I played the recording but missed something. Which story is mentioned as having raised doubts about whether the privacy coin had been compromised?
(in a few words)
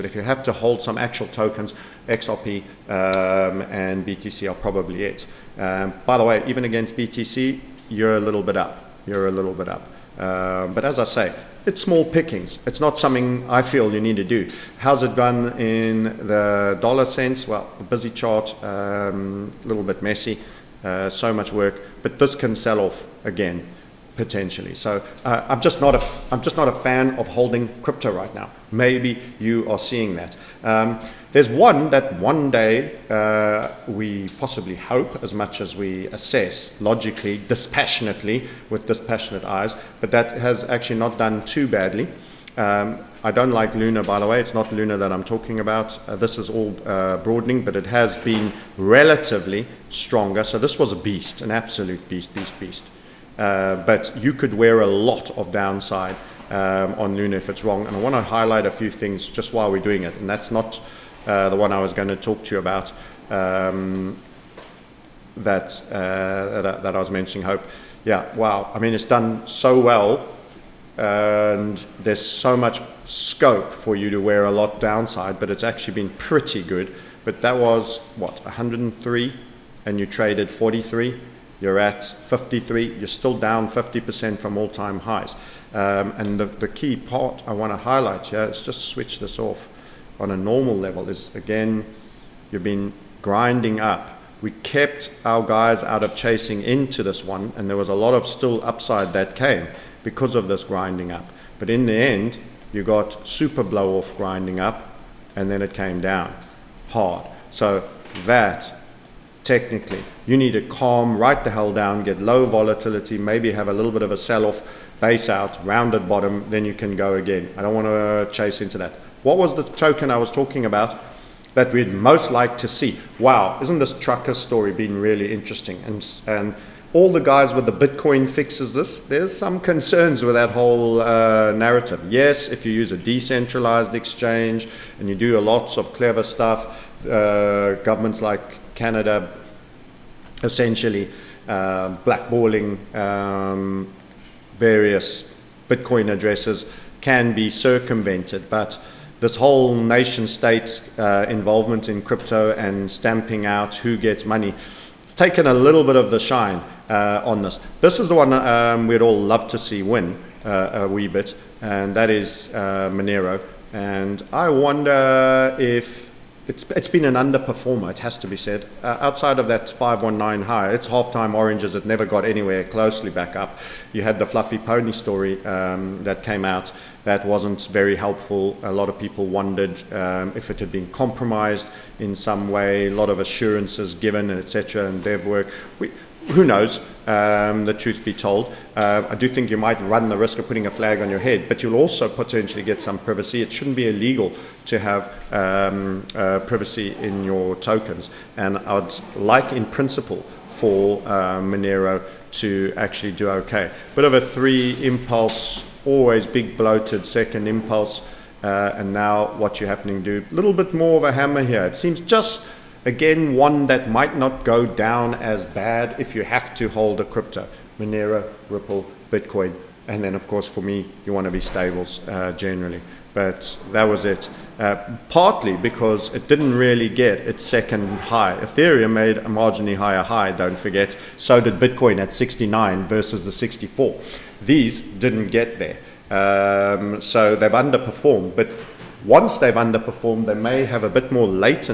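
The Fluffypony story.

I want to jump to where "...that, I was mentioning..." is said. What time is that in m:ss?
1:06.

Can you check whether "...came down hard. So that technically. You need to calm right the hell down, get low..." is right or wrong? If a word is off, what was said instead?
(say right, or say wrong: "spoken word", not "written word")
right.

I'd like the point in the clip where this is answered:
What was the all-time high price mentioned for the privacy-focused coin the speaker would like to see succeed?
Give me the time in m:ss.
2:49.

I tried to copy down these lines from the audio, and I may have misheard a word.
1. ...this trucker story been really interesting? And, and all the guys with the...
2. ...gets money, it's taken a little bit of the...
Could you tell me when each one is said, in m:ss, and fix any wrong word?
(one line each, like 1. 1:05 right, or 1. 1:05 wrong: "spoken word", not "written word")
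1. 2:03 right
2. 2:33 right.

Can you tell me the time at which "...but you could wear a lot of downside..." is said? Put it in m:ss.
0:53.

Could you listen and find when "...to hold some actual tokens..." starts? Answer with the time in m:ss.
0:00.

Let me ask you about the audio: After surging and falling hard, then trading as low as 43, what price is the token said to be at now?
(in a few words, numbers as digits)
53.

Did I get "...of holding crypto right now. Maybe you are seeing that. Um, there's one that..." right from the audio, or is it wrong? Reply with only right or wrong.
right.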